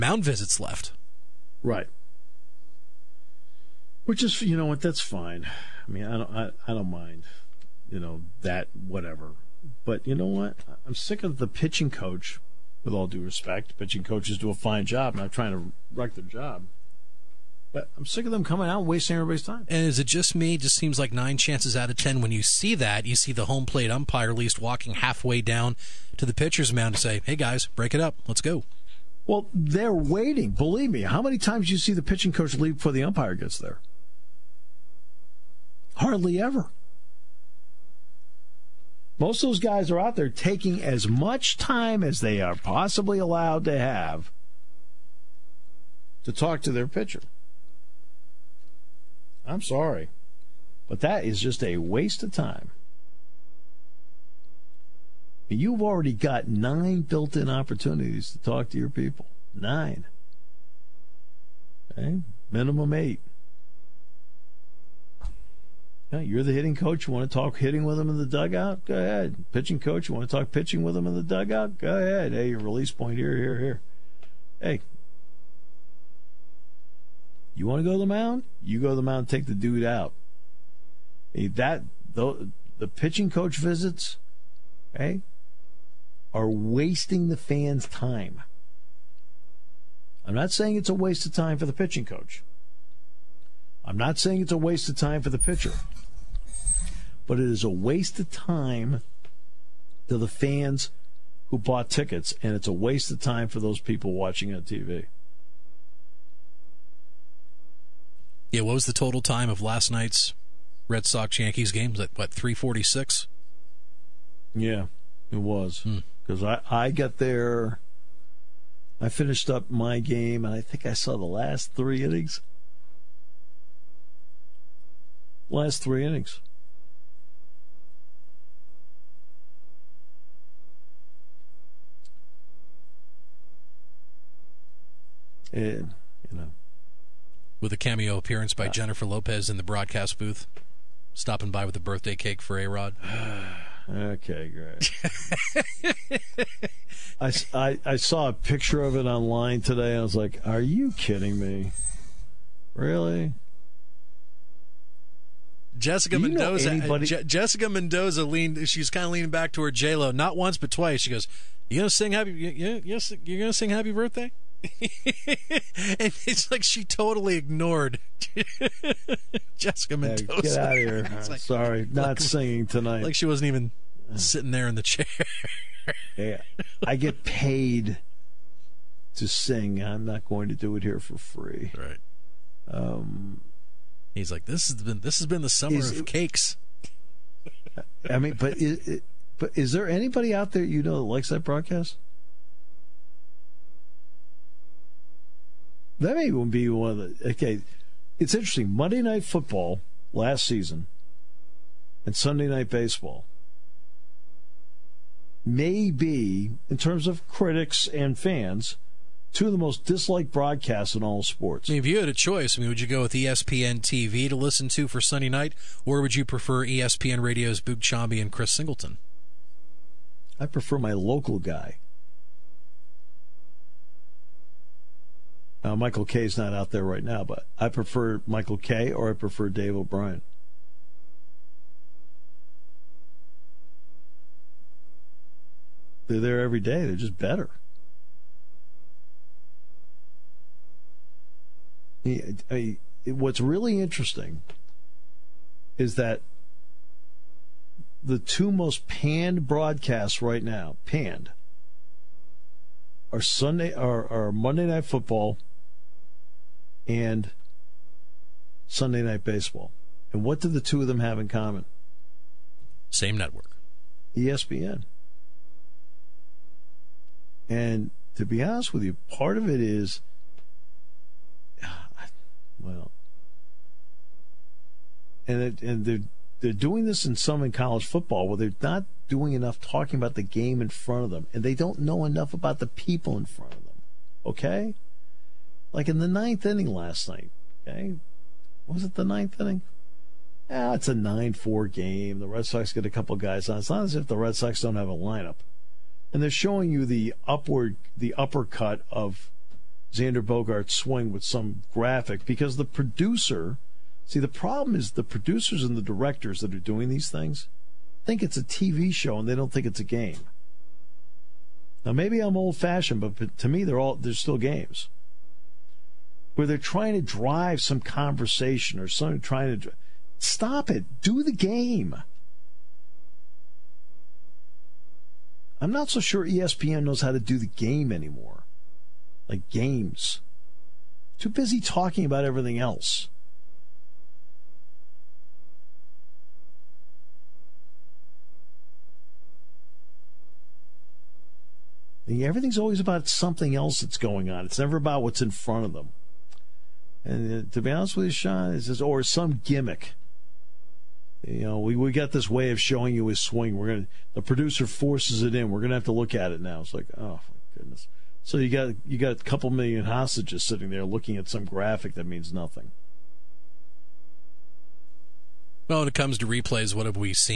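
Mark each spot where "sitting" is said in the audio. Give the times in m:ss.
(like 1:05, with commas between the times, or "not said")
2:54, 6:00.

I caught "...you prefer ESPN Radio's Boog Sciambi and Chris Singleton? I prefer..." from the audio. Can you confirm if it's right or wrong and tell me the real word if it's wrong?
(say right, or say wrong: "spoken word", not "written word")
right.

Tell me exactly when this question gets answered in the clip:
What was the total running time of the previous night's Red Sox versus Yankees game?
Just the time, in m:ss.
1:52.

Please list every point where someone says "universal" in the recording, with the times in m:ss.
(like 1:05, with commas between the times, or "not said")
not said.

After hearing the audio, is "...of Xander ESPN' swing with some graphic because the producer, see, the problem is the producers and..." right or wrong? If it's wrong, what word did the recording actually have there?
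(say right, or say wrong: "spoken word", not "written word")
wrong: "Bogaerts", not "ESPN".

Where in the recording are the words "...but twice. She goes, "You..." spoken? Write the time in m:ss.
2:40.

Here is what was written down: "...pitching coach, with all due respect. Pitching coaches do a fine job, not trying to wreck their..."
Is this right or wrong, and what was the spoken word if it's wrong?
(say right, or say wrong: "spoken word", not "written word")
right.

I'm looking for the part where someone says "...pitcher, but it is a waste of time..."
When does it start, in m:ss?
1:35.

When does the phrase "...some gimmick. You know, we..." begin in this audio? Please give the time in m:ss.
5:49.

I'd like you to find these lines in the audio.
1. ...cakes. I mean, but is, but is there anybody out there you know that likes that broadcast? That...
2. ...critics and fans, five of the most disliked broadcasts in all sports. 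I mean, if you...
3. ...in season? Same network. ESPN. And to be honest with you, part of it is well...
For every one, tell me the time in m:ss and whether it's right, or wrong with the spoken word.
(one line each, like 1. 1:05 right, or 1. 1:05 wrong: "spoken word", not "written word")
1. 3:06 right
2. 3:27 wrong: "two", not "five"
3. 4:21 wrong: "common", not "season".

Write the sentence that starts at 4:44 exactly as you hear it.
Okay, like in the ninth inning last night.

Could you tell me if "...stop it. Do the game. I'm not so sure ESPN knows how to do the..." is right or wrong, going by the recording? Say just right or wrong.
right.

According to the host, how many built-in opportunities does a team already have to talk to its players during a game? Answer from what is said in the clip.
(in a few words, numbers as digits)
9.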